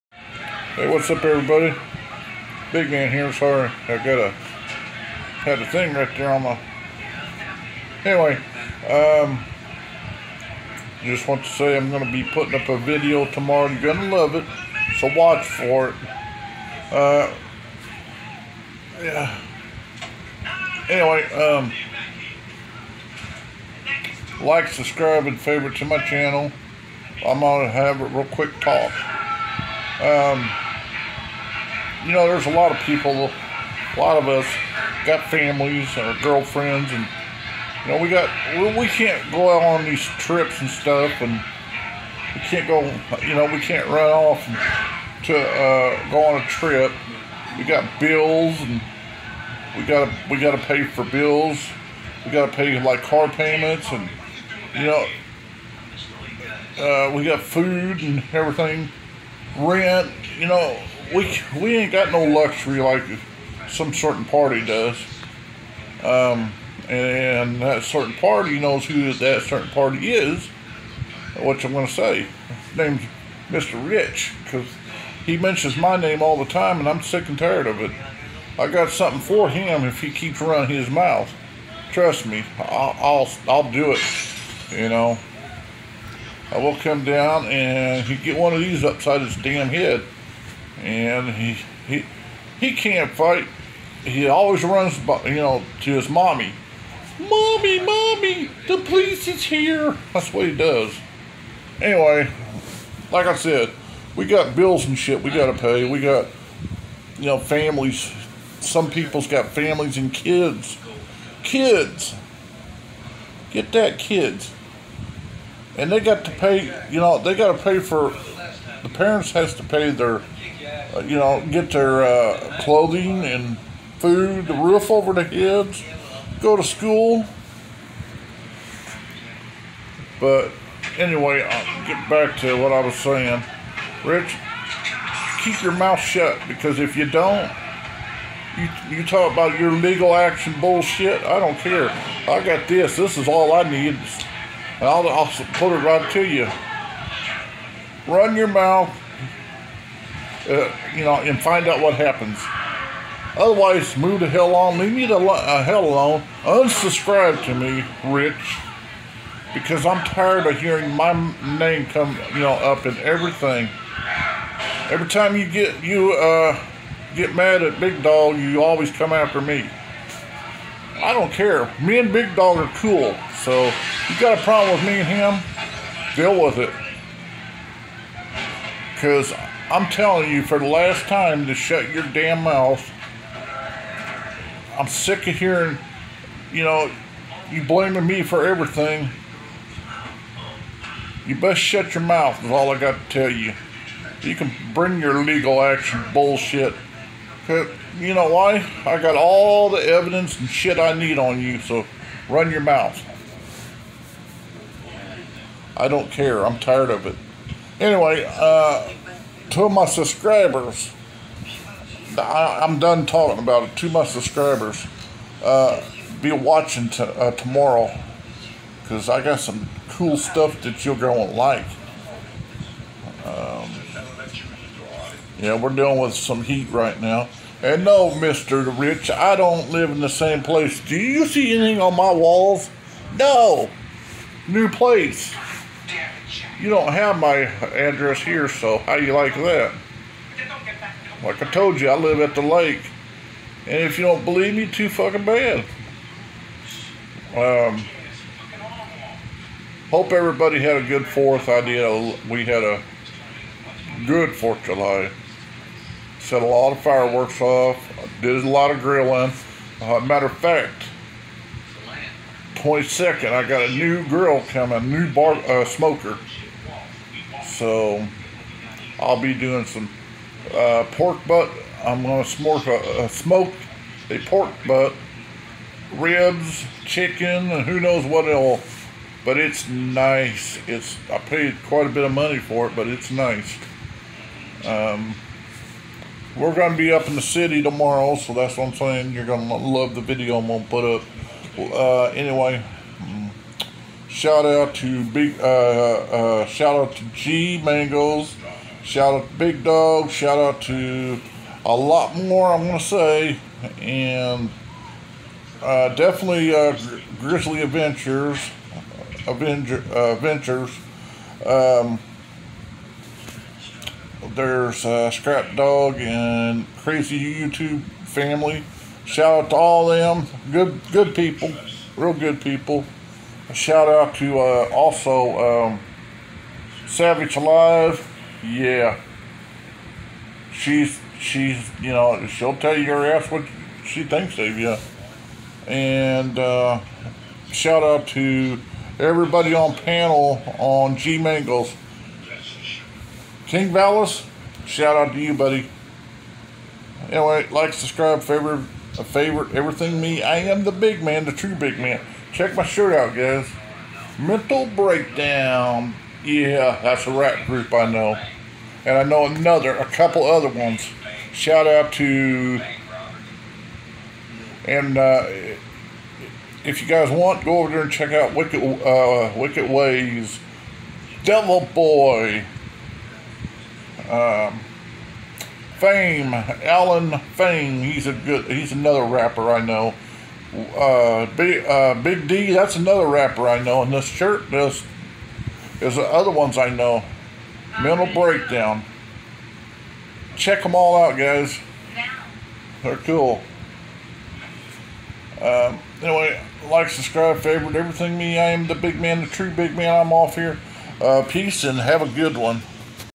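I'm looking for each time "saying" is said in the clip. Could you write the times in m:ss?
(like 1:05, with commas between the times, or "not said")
2:12, 4:48.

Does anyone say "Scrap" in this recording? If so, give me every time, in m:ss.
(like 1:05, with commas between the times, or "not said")
5:15.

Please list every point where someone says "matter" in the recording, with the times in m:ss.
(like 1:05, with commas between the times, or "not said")
4:20.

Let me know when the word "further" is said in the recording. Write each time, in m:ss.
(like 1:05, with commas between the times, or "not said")
not said.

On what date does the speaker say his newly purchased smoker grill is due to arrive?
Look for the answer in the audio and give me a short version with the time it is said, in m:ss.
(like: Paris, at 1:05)
22nd, at 4:22.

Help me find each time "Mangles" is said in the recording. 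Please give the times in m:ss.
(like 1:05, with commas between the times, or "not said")
4:57, 5:41.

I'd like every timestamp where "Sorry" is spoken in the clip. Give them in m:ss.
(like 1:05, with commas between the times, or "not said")
0:03.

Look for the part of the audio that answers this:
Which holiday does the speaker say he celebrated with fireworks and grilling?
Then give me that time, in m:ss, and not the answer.
4:14.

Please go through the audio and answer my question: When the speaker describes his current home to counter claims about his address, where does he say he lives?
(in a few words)
At the lake.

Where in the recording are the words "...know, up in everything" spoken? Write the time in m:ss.
2:42.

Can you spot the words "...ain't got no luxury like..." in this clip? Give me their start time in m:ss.
1:01.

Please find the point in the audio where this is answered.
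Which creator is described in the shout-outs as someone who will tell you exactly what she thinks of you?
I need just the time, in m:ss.
5:26.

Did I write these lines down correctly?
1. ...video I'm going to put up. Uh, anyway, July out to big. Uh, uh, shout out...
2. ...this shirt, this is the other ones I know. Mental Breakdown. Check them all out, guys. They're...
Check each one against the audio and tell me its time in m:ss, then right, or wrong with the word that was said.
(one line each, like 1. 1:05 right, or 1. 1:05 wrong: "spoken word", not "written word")
1. 4:50 wrong: "Shout", not "July"
2. 6:23 right.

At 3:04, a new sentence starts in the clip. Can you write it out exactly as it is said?
I'm sick of hearing, you know, you blaming me for everything.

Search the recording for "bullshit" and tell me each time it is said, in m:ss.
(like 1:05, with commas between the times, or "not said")
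2:20, 3:16.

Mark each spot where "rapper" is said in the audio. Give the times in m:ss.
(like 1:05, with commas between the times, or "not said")
6:19, 6:23.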